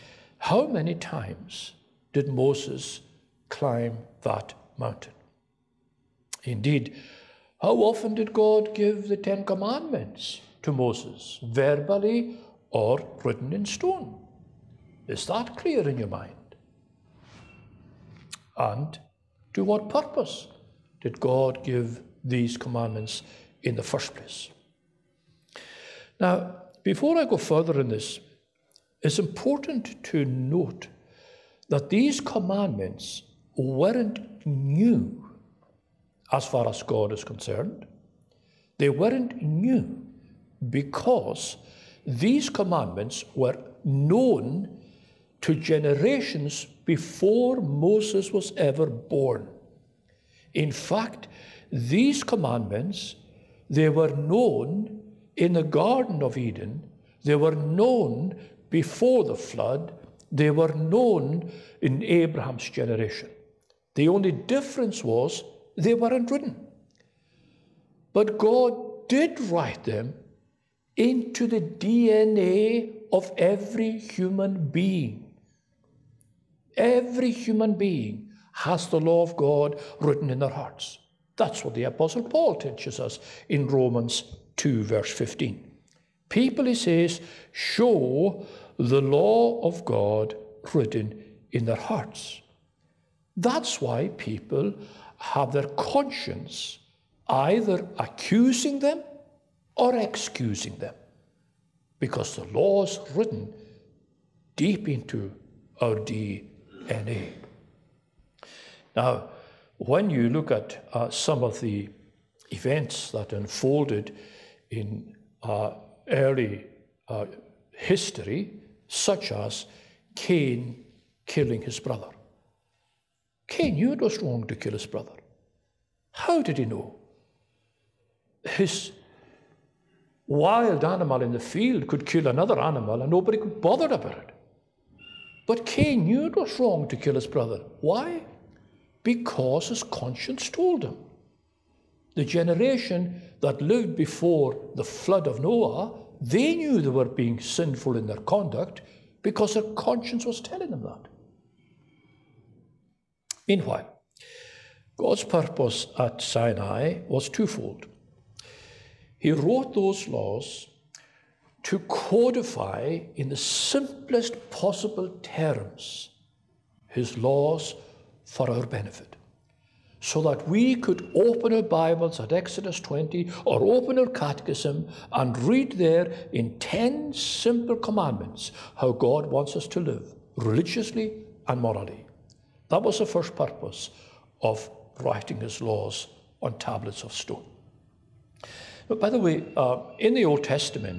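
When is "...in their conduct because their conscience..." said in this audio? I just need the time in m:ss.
2:27.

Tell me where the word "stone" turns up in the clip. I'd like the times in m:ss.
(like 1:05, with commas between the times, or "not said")
0:13, 3:07.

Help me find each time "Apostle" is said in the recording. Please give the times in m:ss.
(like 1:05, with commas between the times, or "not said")
1:21.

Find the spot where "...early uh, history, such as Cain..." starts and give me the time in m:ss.
1:56.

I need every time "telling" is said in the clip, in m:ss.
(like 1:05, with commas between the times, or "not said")
2:30.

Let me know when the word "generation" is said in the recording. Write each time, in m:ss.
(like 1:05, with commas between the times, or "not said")
0:45, 1:02, 2:22.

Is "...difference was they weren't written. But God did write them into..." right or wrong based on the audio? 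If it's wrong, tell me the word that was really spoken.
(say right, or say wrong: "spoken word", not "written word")
right.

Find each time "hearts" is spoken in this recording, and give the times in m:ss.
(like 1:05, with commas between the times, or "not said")
1:20, 1:31.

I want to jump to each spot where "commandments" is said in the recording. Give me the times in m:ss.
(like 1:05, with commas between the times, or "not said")
0:09, 0:22, 0:32, 0:42, 0:52, 2:57.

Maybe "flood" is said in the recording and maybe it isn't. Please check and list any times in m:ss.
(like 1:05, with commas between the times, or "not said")
0:59, 2:24.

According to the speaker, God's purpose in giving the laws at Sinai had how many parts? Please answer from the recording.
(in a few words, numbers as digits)
2 (twofold).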